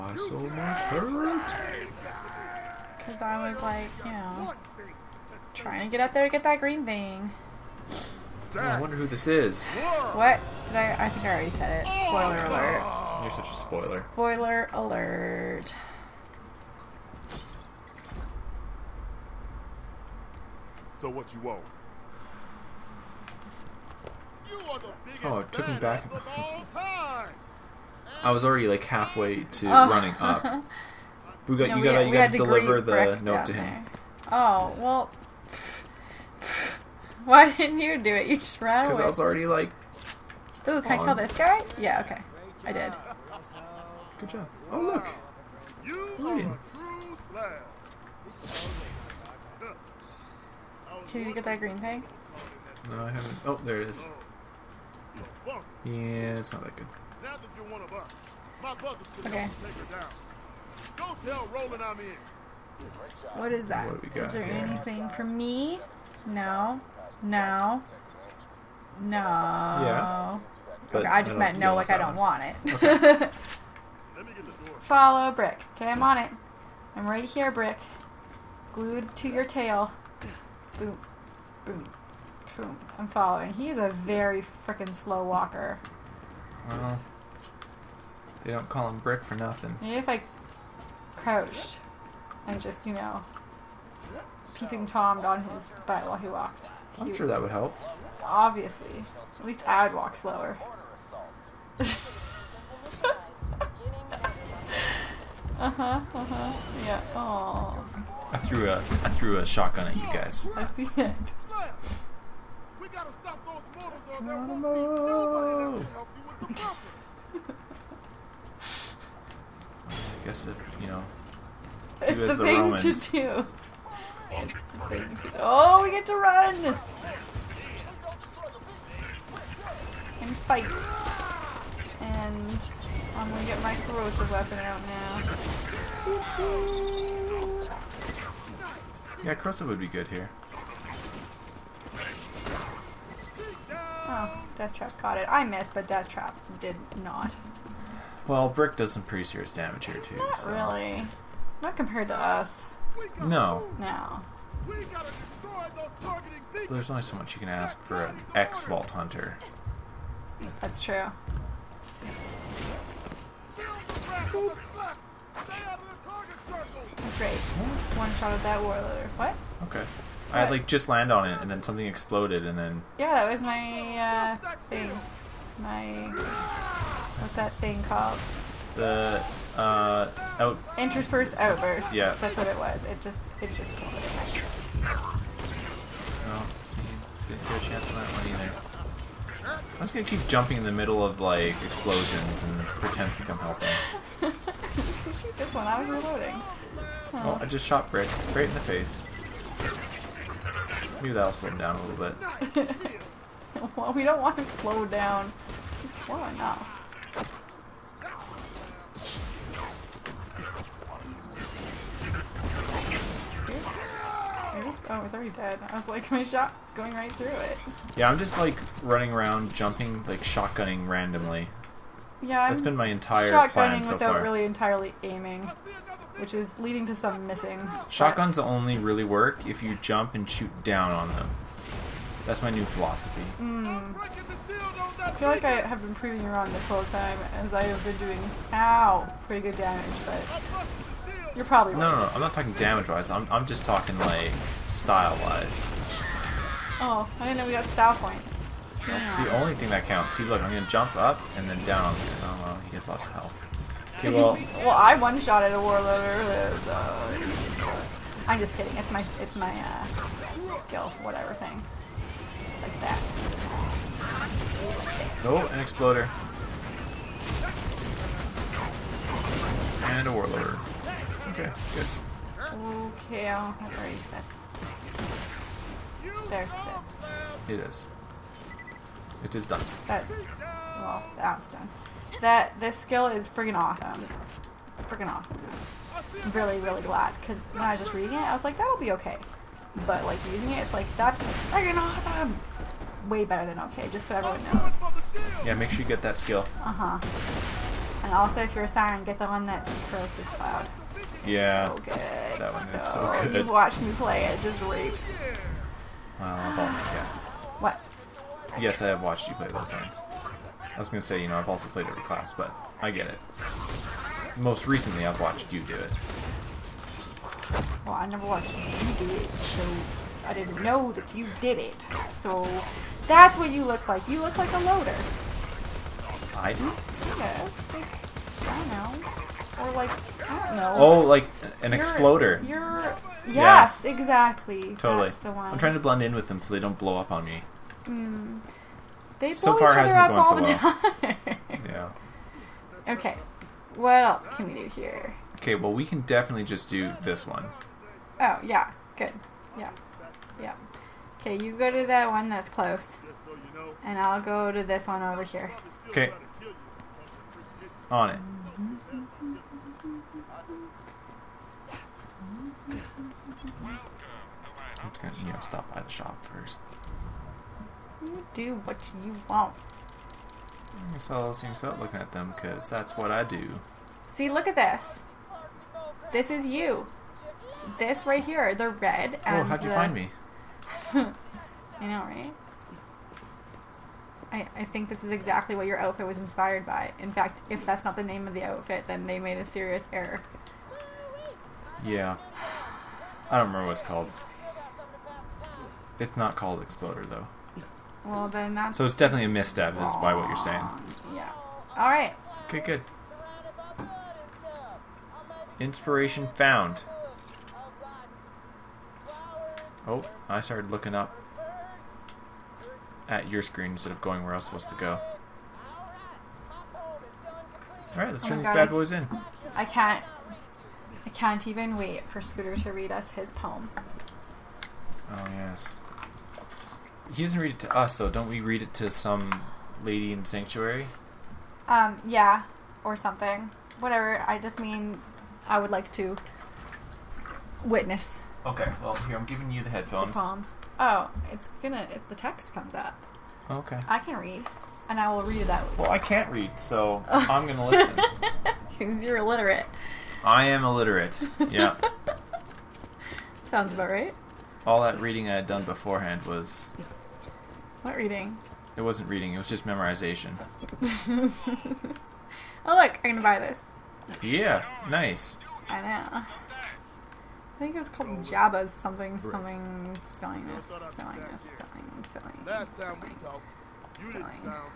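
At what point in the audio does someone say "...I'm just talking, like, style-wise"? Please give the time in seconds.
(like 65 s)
243 s.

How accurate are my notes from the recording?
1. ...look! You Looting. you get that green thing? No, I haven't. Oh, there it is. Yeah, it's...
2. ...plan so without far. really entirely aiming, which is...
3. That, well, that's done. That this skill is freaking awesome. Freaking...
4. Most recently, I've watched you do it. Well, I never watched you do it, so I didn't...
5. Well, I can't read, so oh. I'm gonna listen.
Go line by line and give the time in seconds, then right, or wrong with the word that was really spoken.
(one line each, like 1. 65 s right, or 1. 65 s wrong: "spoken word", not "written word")
1. 44 s right
2. 223 s right
3. 279 s right
4. 314 s right
5. 445 s right.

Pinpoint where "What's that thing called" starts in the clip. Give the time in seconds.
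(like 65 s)
177 s.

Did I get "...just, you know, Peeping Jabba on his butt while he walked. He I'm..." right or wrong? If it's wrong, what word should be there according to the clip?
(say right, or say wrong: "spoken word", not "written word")
wrong: "Tommed", not "Jabba".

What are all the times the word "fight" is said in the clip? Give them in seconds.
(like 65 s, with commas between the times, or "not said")
130 s.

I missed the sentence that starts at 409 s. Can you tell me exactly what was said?
Oh, I started looking up at your screen instead of going where I was supposed to go.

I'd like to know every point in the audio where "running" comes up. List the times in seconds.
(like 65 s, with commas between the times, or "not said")
29 s, 218 s.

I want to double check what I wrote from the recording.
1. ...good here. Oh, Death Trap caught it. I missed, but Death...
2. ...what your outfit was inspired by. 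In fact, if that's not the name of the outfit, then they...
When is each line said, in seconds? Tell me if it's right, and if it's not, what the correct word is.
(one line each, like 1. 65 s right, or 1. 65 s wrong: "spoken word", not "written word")
1. 139 s right
2. 385 s right.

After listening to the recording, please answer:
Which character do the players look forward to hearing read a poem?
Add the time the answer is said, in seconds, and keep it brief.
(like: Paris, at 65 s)
Scooter, at 422 s.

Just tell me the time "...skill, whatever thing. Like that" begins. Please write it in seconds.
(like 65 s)
260 s.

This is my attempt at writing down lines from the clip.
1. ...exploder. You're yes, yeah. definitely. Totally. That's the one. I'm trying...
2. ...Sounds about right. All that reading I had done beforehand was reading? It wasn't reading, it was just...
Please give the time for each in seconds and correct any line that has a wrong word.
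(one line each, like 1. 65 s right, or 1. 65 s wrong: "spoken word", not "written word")
1. 331 s wrong: "exactly", not "definitely"
2. 453 s right.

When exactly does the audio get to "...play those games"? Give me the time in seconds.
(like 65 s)
309 s.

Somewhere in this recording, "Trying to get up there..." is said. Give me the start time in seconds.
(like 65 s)
5 s.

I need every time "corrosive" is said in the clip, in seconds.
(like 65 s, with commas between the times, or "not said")
133 s, 139 s.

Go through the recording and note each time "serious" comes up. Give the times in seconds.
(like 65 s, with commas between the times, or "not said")
149 s, 389 s.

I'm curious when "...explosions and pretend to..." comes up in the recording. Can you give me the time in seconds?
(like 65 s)
191 s.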